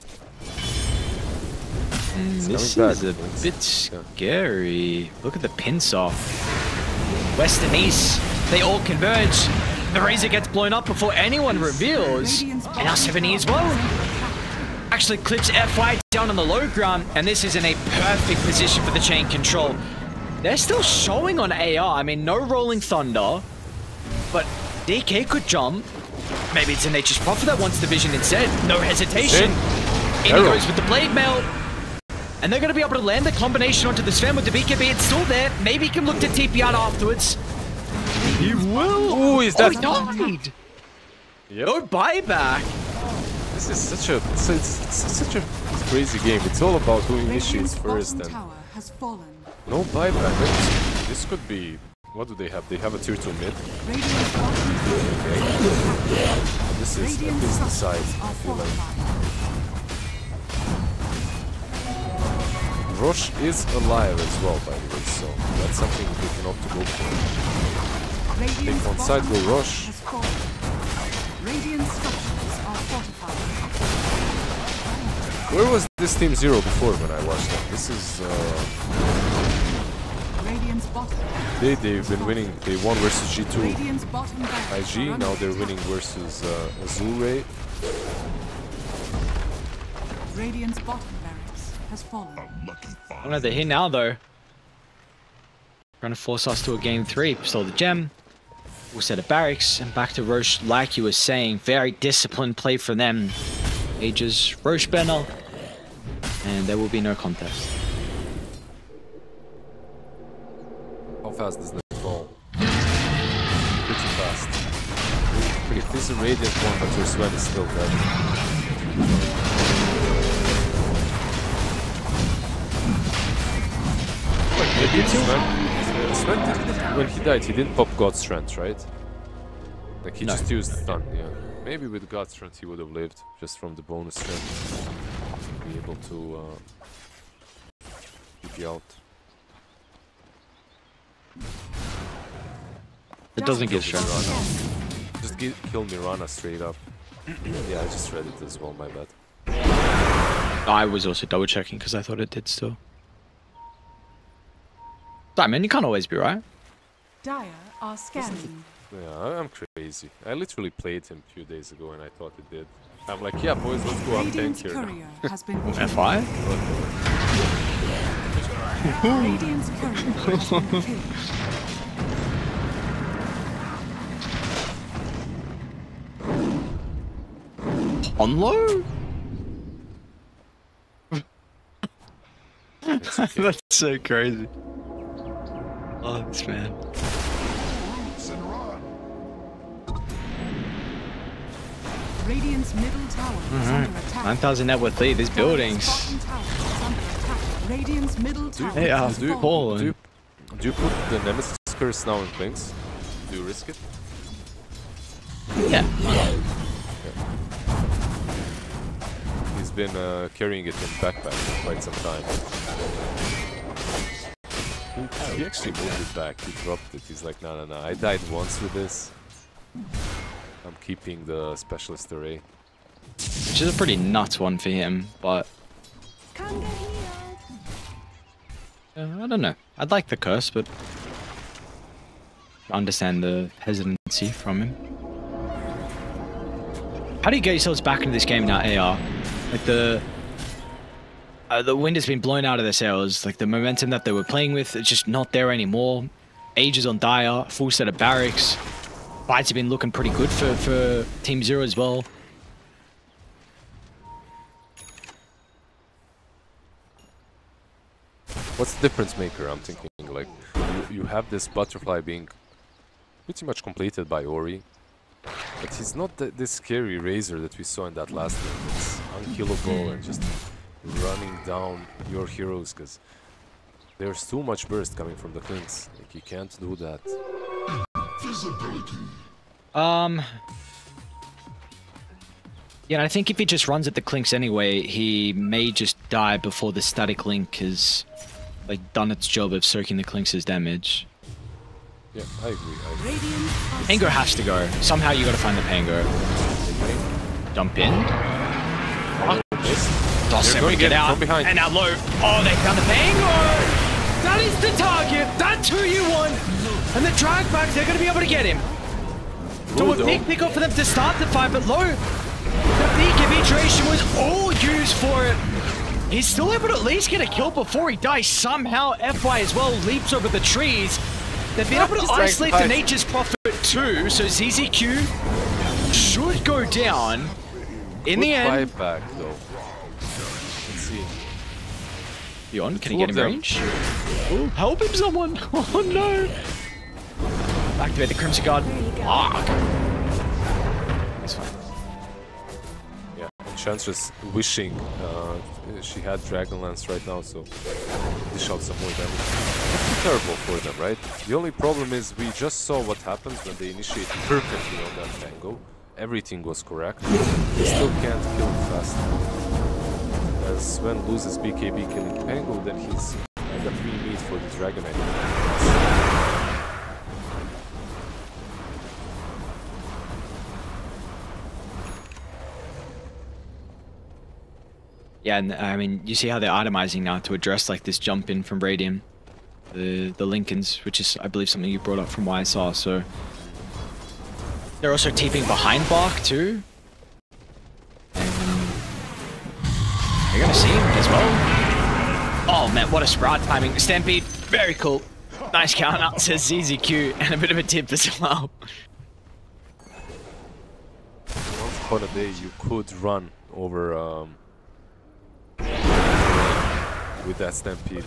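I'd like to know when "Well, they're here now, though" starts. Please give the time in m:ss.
1:33.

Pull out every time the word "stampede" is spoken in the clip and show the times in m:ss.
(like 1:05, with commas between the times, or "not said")
6:33, 6:47.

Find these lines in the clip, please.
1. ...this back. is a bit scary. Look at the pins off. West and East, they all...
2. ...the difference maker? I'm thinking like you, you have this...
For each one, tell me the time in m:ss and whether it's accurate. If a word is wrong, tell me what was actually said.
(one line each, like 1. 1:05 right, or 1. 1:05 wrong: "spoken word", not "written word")
1. 0:02 right
2. 4:18 right.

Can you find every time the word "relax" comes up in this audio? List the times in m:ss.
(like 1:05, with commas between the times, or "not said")
not said.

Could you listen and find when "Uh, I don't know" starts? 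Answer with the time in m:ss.
3:46.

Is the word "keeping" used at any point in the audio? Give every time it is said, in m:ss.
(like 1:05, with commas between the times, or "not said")
3:40.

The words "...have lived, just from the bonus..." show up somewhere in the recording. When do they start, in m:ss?
2:12.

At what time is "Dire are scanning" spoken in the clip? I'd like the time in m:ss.
2:37.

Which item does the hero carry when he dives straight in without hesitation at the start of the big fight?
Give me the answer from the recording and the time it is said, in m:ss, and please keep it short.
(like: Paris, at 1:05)
Blade Mail, at 0:30.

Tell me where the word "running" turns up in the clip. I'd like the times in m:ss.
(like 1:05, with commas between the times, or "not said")
4:30.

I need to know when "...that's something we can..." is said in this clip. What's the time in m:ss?
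1:05.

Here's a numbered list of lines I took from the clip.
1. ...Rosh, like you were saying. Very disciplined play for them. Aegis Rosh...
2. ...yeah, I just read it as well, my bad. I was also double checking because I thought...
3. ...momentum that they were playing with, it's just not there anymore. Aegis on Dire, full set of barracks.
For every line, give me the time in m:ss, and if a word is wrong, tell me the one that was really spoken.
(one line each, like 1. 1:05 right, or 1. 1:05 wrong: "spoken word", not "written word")
1. 1:40 right
2. 2:27 right
3. 4:03 right.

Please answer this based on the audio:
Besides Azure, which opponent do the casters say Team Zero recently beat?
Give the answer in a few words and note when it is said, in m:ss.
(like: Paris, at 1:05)
G2 IG, at 1:23.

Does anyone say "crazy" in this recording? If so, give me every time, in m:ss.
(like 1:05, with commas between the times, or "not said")
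0:45, 2:39, 3:03.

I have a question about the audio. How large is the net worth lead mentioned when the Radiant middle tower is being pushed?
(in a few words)
9,000.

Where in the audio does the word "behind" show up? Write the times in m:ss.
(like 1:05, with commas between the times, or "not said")
5:01, 6:25.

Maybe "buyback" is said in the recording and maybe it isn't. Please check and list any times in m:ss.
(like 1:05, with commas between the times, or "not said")
0:41, 0:49.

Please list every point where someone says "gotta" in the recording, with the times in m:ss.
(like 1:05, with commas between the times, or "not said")
4:55.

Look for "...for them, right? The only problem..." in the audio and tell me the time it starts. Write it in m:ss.
5:50.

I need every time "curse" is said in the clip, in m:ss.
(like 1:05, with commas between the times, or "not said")
3:21, 3:50.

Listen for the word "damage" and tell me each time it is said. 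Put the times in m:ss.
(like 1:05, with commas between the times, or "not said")
4:50, 5:49.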